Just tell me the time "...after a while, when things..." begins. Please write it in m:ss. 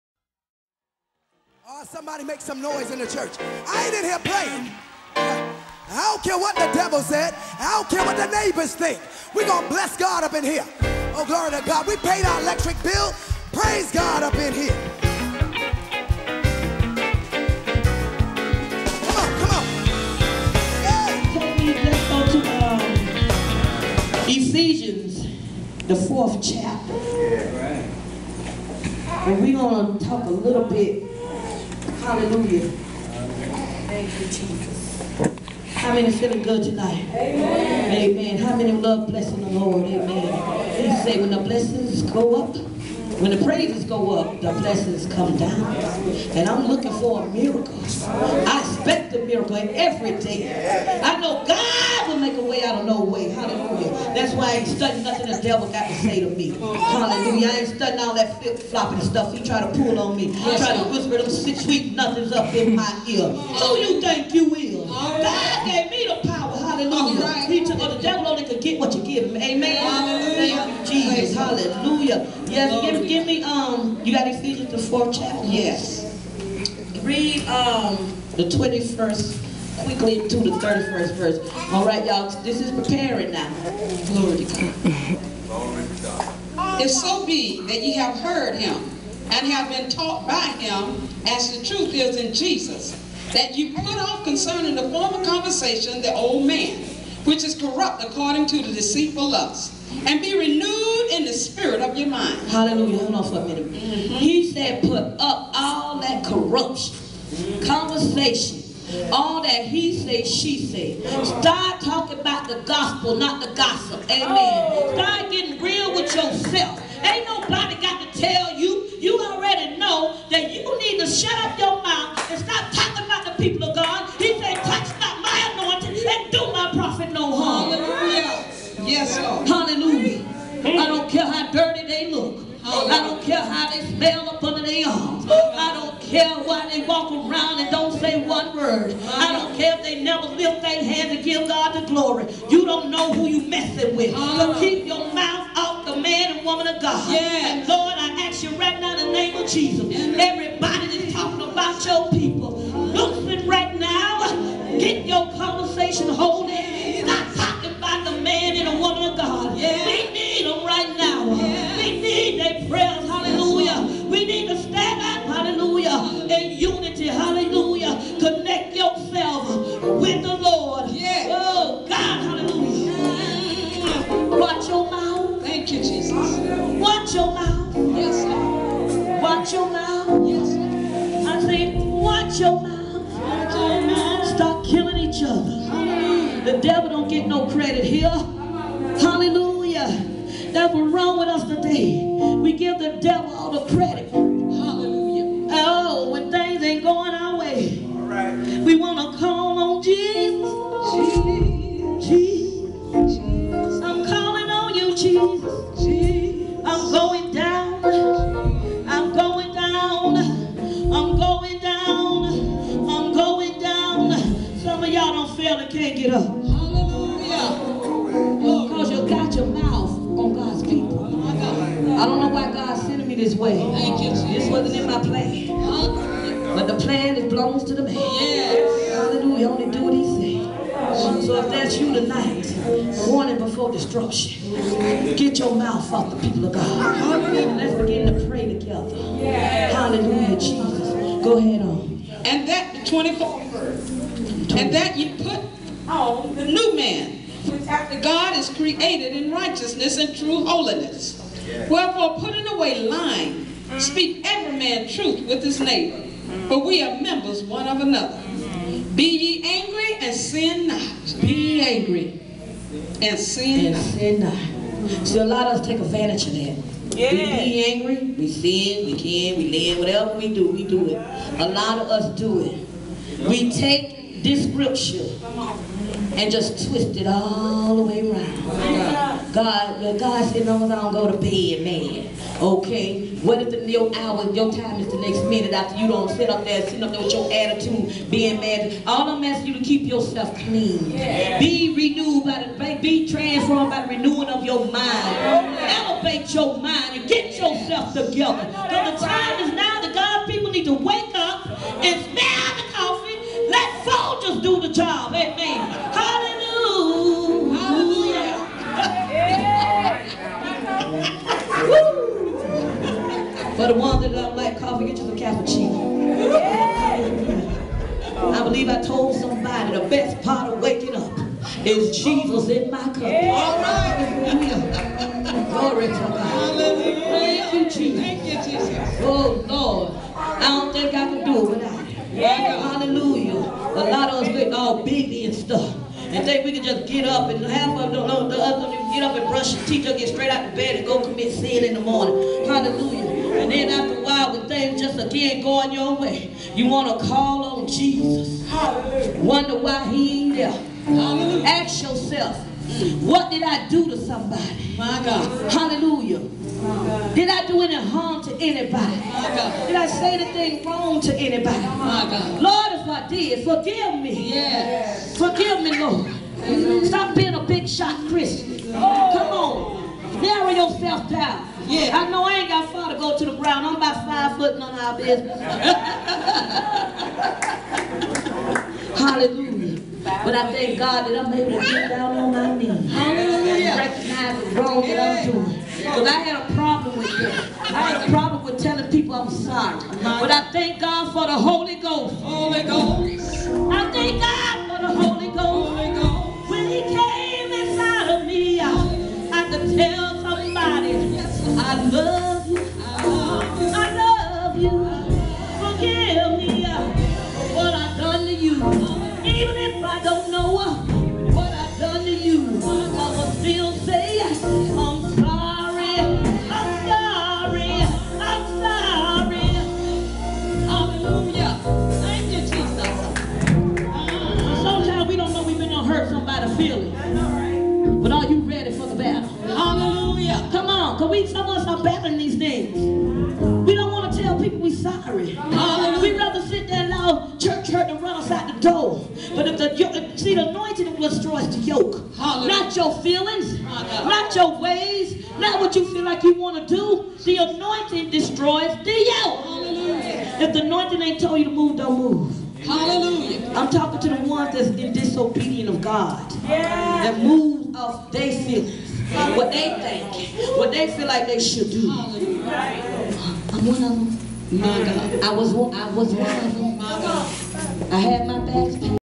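5:43.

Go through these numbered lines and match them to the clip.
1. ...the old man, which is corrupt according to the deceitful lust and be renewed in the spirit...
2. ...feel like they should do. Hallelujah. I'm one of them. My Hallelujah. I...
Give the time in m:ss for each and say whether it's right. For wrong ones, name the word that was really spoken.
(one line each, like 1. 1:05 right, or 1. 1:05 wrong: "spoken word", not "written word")
1. 1:36 right
2. 7:40 wrong: "God", not "Hallelujah".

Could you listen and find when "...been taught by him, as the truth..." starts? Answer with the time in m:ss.
1:29.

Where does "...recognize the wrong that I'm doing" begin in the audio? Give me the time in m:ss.
6:23.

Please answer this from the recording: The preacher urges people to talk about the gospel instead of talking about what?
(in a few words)
The gossip.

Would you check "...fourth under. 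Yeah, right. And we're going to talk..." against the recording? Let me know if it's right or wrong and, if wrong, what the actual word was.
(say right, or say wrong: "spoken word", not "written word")
wrong: "chapter", not "under".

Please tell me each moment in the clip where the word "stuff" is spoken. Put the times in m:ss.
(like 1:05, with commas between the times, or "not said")
0:59, 5:35.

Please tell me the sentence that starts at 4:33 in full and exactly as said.
We take this scripture and just twist it all the way around.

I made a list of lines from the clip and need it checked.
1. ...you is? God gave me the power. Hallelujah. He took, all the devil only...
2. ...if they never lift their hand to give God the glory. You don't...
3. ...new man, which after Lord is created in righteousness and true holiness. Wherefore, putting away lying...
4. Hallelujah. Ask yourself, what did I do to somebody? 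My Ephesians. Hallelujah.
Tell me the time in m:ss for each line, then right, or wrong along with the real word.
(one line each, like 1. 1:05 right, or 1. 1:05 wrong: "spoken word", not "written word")
1. 1:04 right
2. 2:19 right
3. 4:06 wrong: "God", not "Lord"
4. 5:50 wrong: "God", not "Ephesians".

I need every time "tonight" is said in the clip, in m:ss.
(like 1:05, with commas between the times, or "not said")
0:36, 3:51.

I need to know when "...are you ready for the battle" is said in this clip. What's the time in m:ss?
7:08.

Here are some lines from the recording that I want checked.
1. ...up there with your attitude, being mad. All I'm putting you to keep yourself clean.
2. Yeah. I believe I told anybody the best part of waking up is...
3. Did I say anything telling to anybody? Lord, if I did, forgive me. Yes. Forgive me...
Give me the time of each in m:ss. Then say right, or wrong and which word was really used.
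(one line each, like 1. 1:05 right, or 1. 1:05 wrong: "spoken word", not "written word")
1. 4:46 wrong: "asking", not "putting"
2. 5:16 wrong: "somebody", not "anybody"
3. 5:59 wrong: "wrong", not "telling".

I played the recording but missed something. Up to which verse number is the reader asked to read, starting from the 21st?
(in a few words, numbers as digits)
31.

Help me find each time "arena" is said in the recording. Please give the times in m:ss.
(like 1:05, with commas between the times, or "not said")
not said.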